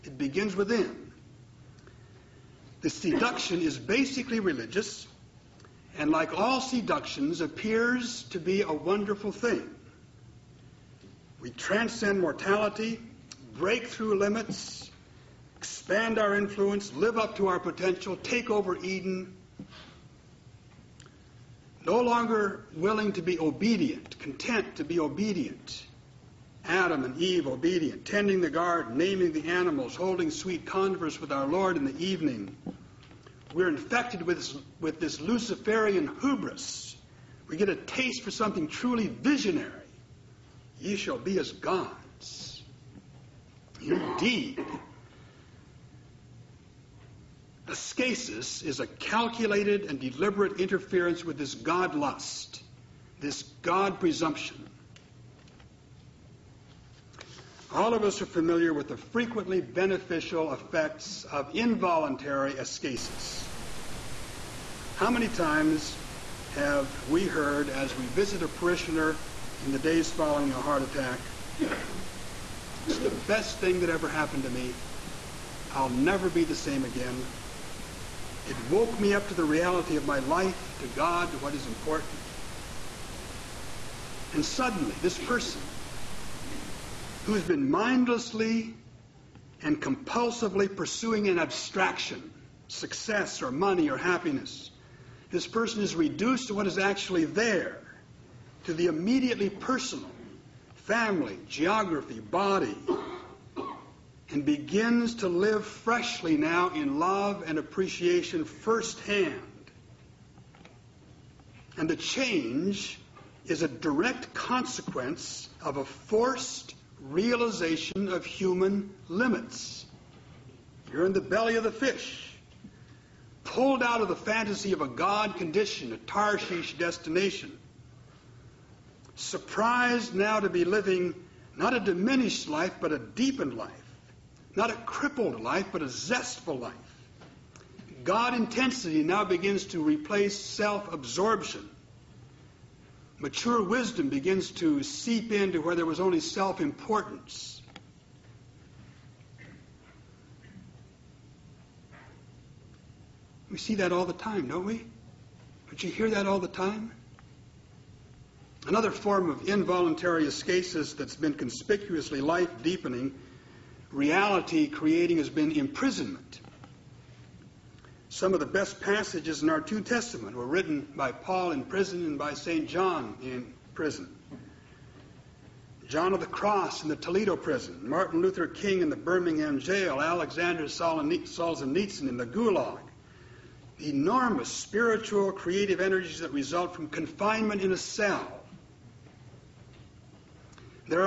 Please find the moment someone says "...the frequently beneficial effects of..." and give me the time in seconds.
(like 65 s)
58 s.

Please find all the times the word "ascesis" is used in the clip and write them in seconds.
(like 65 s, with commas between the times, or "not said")
47 s, 62 s, 160 s.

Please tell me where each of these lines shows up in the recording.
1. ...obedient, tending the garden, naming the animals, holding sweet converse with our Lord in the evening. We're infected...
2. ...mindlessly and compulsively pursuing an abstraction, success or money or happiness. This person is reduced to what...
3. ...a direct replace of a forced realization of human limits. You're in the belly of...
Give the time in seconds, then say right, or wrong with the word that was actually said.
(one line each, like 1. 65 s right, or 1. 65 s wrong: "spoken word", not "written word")
1. 27 s right
2. 87 s right
3. 113 s wrong: "consequence", not "replace".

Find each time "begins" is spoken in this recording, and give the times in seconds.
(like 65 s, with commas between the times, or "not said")
0 s, 104 s, 139 s, 144 s.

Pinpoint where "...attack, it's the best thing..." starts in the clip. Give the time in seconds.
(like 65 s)
70 s.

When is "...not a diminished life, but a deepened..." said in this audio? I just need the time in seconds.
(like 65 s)
131 s.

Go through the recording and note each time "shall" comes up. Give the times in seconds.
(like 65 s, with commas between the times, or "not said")
40 s.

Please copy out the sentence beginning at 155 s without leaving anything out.
Don't you hear that all the time?